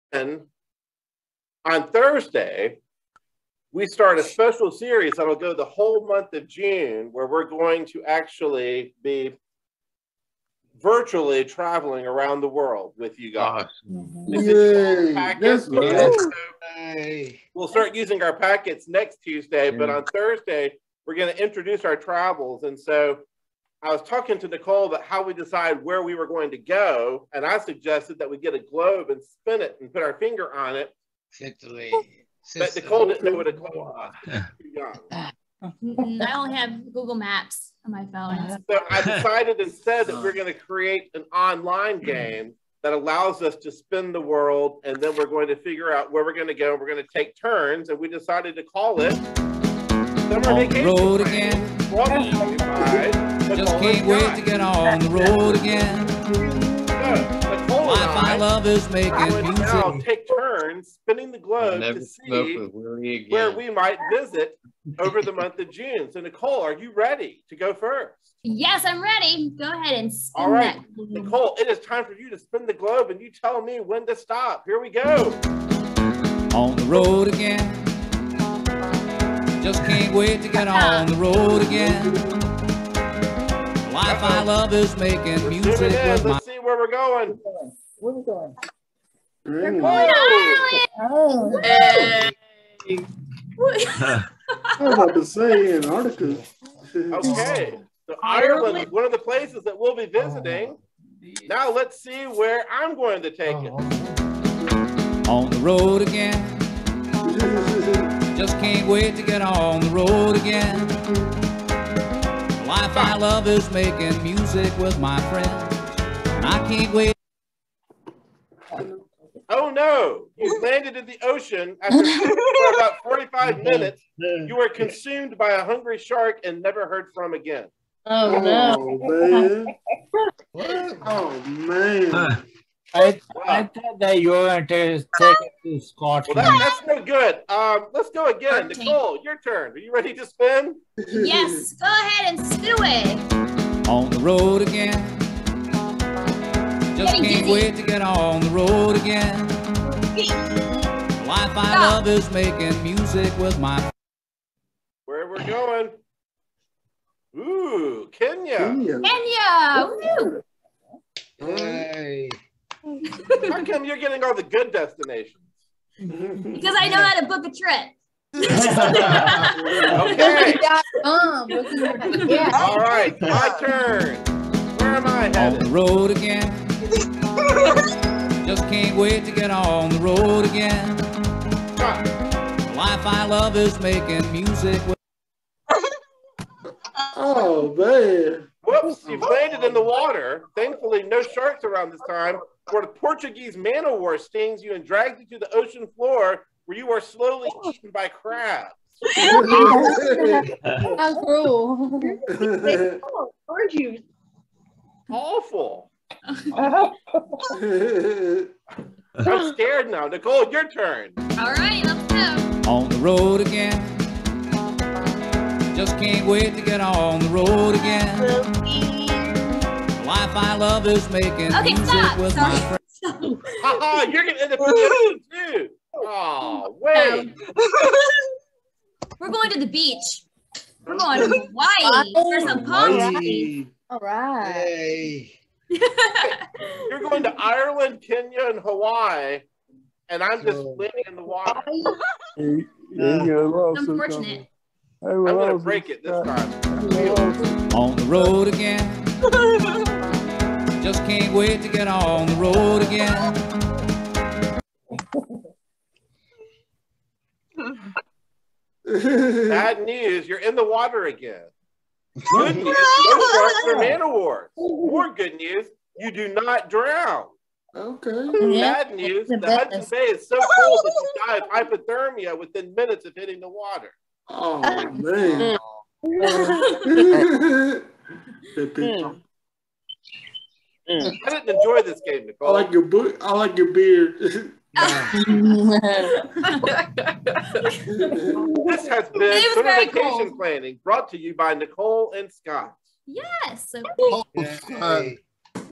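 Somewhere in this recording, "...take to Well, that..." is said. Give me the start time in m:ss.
2:15.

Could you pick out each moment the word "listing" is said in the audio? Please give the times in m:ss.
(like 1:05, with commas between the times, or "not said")
not said.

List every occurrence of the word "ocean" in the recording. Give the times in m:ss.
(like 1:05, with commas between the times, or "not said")
2:01, 3:15.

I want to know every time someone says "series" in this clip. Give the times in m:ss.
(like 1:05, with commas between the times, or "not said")
0:04.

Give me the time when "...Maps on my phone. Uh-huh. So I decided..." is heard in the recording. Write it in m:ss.
0:37.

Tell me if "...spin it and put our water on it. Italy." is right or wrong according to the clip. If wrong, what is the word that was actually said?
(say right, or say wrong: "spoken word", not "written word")
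wrong: "finger", not "water".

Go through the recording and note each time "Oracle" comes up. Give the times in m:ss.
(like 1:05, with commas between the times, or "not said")
not said.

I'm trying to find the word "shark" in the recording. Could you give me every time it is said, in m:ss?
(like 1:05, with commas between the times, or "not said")
2:05, 3:11.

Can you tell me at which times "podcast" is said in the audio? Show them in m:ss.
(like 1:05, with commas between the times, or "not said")
not said.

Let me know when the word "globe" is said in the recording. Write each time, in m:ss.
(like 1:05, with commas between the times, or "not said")
0:28, 0:33, 1:01, 1:12.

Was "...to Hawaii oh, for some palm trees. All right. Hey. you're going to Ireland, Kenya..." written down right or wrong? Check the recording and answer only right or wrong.
right.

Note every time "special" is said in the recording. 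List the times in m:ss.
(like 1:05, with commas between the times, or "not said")
0:04.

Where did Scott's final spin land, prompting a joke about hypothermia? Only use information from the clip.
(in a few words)
Hudson Bay.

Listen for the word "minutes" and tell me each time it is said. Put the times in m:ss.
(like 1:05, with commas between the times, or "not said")
2:03, 4:32.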